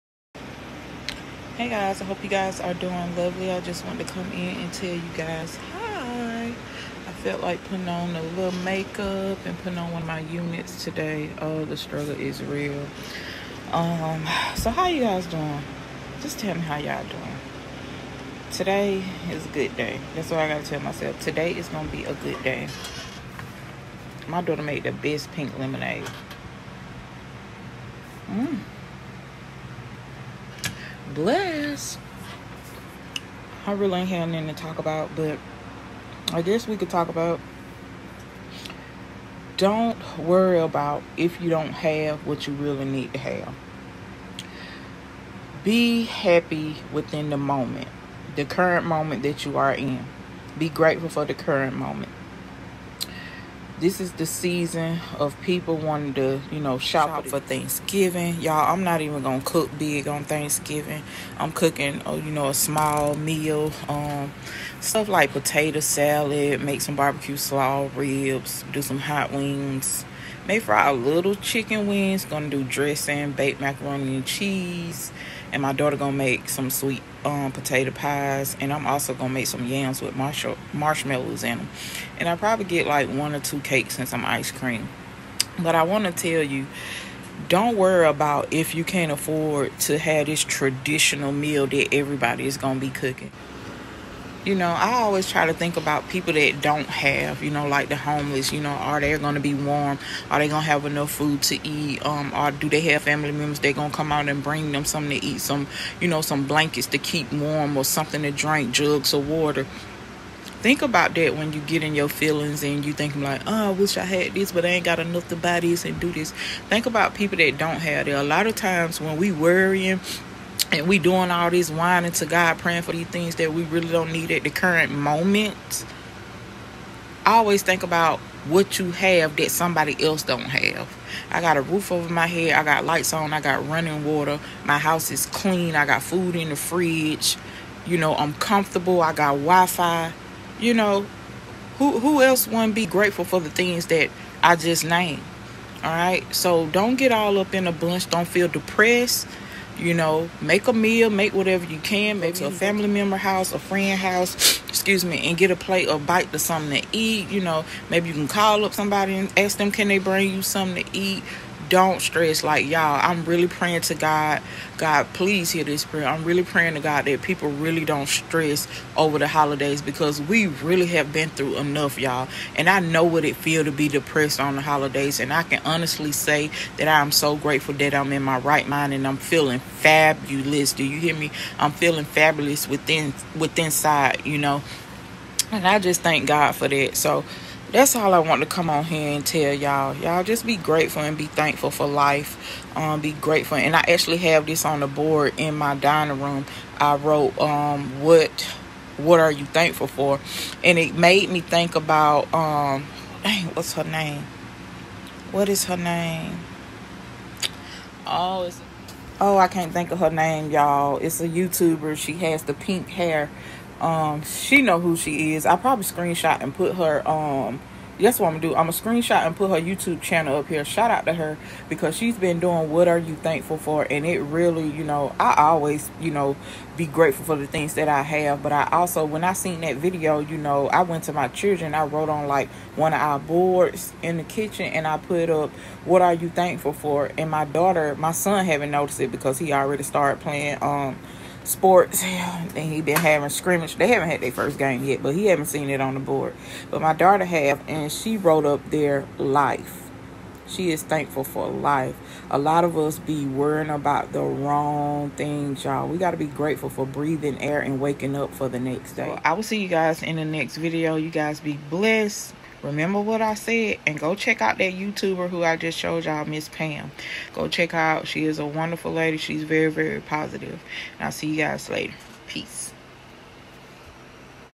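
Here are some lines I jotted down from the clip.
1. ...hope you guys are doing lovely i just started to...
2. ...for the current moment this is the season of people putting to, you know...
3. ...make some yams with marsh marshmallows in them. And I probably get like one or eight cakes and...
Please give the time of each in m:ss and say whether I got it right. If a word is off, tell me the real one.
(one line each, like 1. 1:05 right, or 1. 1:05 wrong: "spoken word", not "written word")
1. 0:02 wrong: "wanted", not "started"
2. 0:51 wrong: "wanting", not "putting"
3. 1:19 wrong: "two", not "eight".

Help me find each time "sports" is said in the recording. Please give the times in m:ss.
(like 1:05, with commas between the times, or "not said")
4:01.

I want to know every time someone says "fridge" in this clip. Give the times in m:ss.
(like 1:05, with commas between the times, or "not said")
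2:16.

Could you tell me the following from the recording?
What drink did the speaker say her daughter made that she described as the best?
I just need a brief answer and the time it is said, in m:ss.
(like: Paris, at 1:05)
Pink lemonade, at 0:25.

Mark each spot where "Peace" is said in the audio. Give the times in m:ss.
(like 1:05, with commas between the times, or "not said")
4:32.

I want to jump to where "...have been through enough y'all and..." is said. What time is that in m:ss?
2:50.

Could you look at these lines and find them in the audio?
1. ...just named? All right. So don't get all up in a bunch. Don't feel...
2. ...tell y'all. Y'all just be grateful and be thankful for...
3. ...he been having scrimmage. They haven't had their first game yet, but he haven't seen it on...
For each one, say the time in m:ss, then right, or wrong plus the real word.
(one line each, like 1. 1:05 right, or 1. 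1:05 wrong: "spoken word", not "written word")
1. 2:24 right
2. 3:09 right
3. 4:02 right.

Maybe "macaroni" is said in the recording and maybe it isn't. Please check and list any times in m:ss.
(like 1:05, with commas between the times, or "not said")
1:13.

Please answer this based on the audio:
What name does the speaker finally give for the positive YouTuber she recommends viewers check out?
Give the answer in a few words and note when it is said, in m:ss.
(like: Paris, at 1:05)
Miss Pam, at 4:26.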